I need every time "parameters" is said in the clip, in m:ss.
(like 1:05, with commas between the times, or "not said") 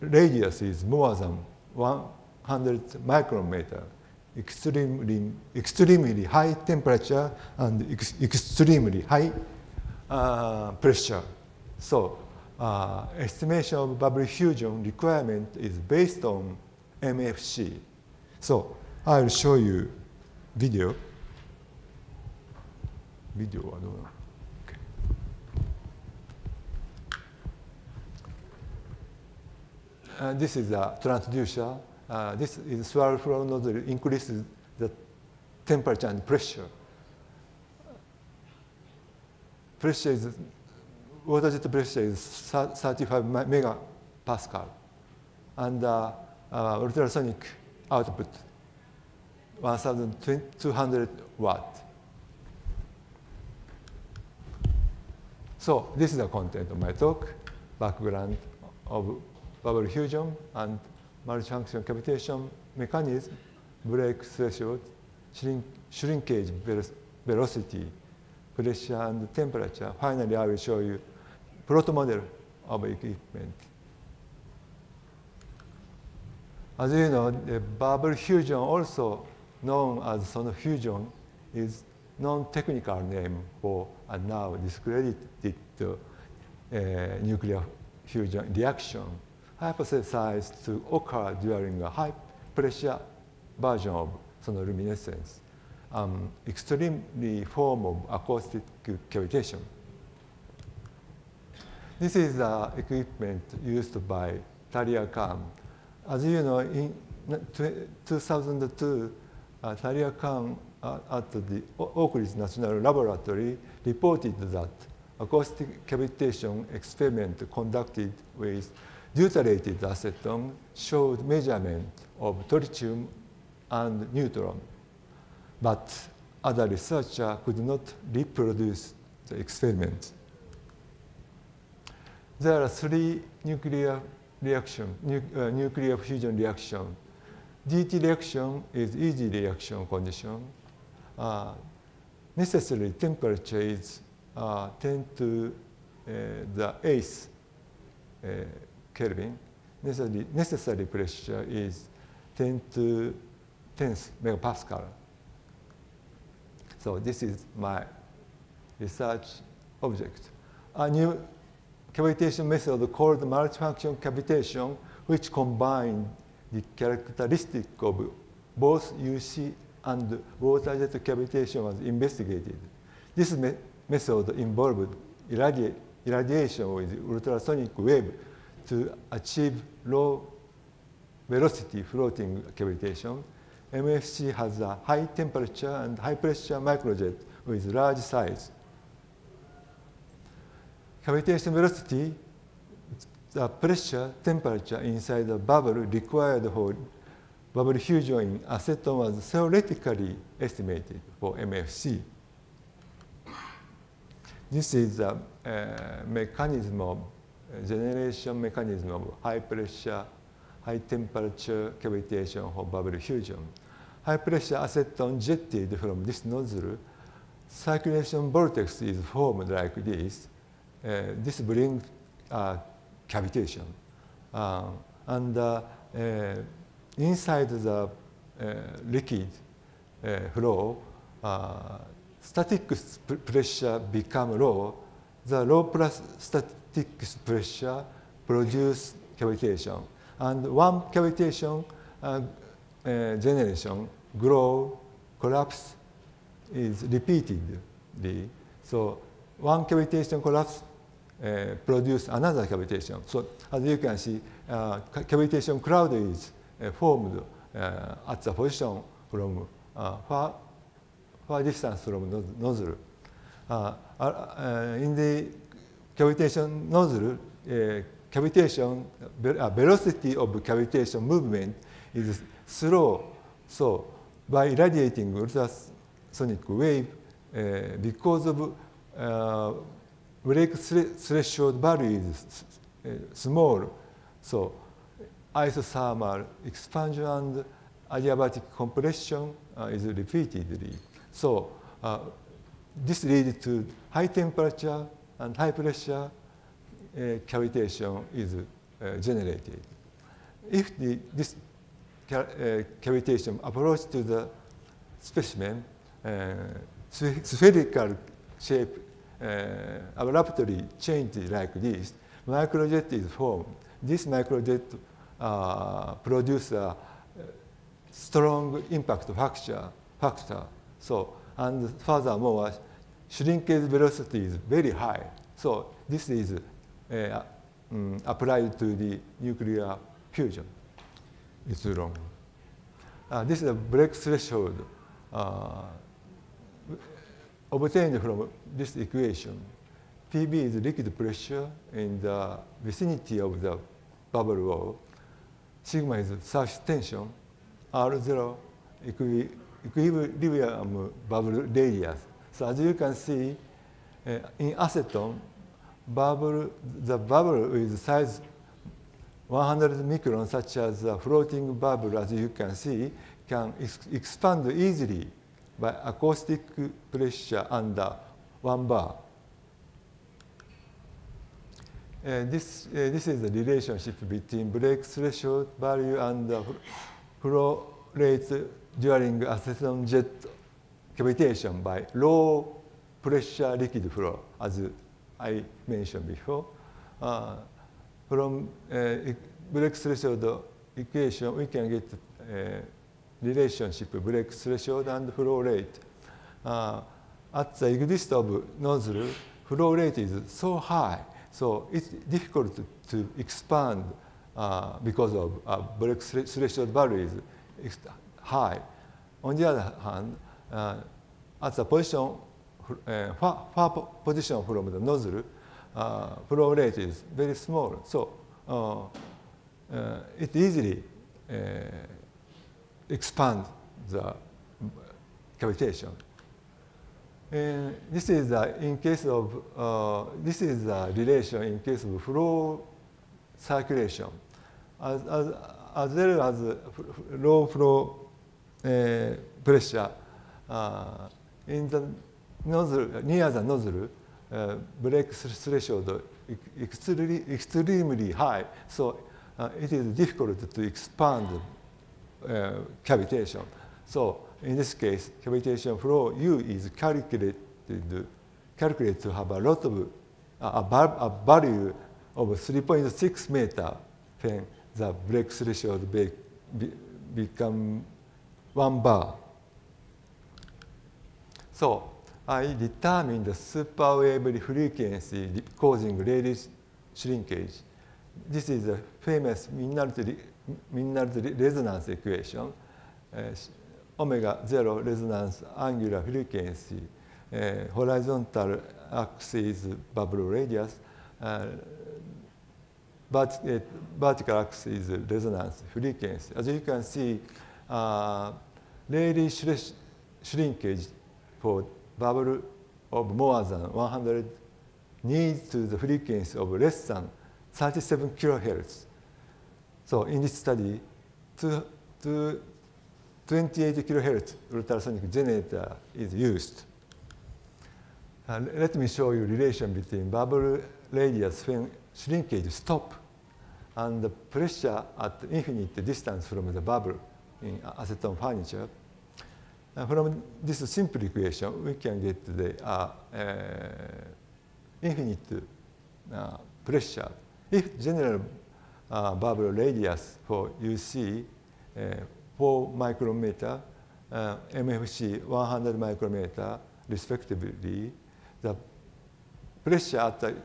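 not said.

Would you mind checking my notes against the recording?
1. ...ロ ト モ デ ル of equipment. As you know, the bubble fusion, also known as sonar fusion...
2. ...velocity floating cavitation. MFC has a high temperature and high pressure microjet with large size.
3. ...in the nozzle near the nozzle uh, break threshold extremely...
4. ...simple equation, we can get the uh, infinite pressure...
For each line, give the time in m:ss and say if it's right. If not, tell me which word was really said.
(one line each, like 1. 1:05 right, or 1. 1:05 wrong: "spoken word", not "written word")
1. 1:11 right
2. 3:01 right
3. 7:21 right
4. 8:50 right.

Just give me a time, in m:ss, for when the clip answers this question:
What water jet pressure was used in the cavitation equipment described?
0:42.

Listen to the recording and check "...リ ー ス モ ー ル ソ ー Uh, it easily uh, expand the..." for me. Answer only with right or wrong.
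right.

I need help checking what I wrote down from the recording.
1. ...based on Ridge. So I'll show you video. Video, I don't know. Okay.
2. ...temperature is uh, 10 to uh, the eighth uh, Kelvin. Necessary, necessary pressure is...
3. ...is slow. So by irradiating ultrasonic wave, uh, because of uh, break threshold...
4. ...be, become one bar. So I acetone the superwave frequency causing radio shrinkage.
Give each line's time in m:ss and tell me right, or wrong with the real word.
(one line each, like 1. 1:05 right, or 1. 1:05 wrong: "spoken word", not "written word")
1. 0:15 wrong: "MFC", not "Ridge"
2. 2:22 right
3. 4:31 right
4. 7:46 wrong: "determine", not "acetone".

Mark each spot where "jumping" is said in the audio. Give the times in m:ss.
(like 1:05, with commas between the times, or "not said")
not said.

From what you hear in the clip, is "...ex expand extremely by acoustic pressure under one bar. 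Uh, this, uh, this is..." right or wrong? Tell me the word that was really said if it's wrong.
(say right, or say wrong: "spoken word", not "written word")
wrong: "easily", not "extremely".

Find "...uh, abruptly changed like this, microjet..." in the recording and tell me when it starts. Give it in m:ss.
5:09.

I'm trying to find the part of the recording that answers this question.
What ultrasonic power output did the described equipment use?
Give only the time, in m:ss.
0:49.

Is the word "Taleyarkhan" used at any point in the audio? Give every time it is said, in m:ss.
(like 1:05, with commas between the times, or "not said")
1:44, 1:49.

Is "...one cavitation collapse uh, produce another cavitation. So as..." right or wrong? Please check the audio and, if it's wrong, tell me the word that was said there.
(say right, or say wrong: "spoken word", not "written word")
right.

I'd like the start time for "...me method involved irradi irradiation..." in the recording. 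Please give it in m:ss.
2:53.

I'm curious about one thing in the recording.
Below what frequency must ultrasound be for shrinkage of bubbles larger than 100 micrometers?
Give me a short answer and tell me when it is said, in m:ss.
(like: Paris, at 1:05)
37 kilohertz, at 8:27.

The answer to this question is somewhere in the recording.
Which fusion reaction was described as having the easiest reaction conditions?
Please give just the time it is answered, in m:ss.
2:17.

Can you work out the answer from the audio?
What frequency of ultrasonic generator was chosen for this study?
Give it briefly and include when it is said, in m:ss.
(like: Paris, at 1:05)
28 kilohertz, at 8:33.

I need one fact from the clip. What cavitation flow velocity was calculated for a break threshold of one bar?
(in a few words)
3.6 meter.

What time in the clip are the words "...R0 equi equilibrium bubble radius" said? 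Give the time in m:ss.
5:47.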